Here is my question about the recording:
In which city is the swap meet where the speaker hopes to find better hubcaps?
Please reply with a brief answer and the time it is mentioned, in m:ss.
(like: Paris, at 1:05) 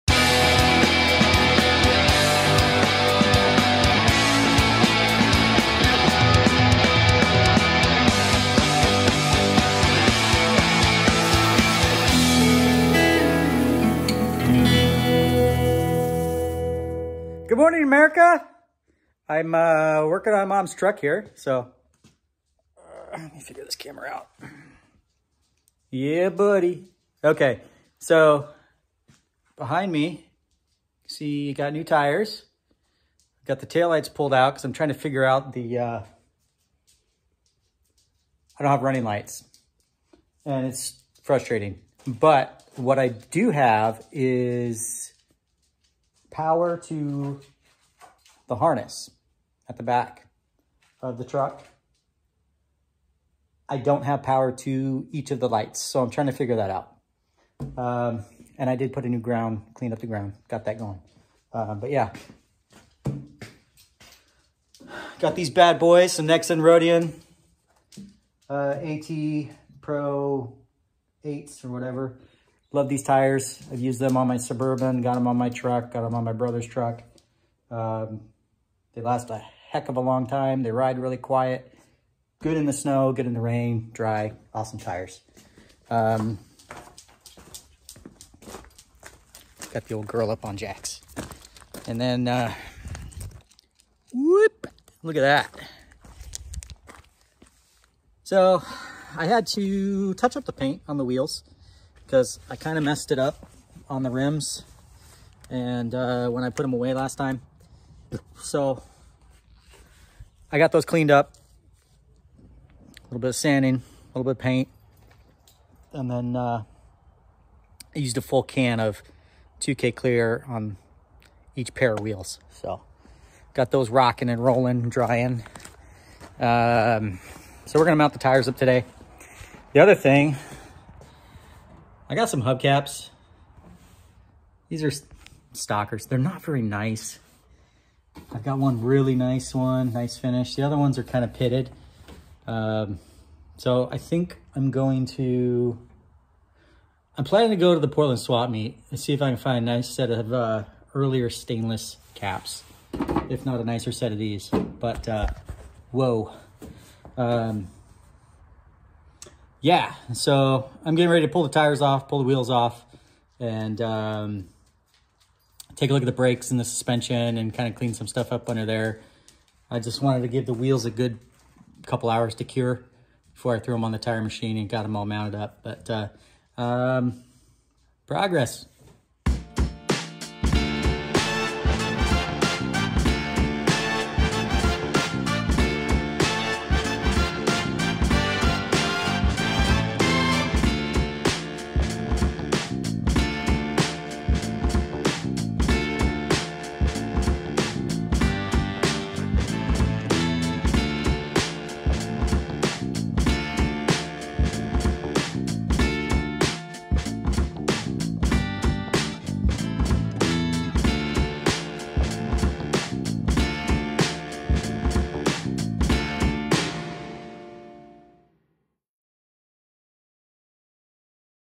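Portland, at 2:27.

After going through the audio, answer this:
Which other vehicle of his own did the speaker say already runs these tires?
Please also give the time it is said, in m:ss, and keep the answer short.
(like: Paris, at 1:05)
Suburban, at 1:14.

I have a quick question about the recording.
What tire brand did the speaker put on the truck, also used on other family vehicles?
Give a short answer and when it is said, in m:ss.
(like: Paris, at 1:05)
Nexen, at 1:06.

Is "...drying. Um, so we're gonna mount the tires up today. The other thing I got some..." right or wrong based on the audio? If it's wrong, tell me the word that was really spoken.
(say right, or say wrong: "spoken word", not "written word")
right.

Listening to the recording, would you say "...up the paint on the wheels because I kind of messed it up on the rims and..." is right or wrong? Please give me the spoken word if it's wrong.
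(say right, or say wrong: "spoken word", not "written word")
right.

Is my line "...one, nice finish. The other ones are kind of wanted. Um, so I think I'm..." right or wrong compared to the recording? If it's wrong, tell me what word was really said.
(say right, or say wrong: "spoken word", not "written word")
wrong: "pitted", not "wanted".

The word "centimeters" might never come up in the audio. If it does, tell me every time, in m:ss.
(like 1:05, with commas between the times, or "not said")
not said.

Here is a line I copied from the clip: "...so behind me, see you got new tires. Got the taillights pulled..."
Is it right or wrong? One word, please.
right.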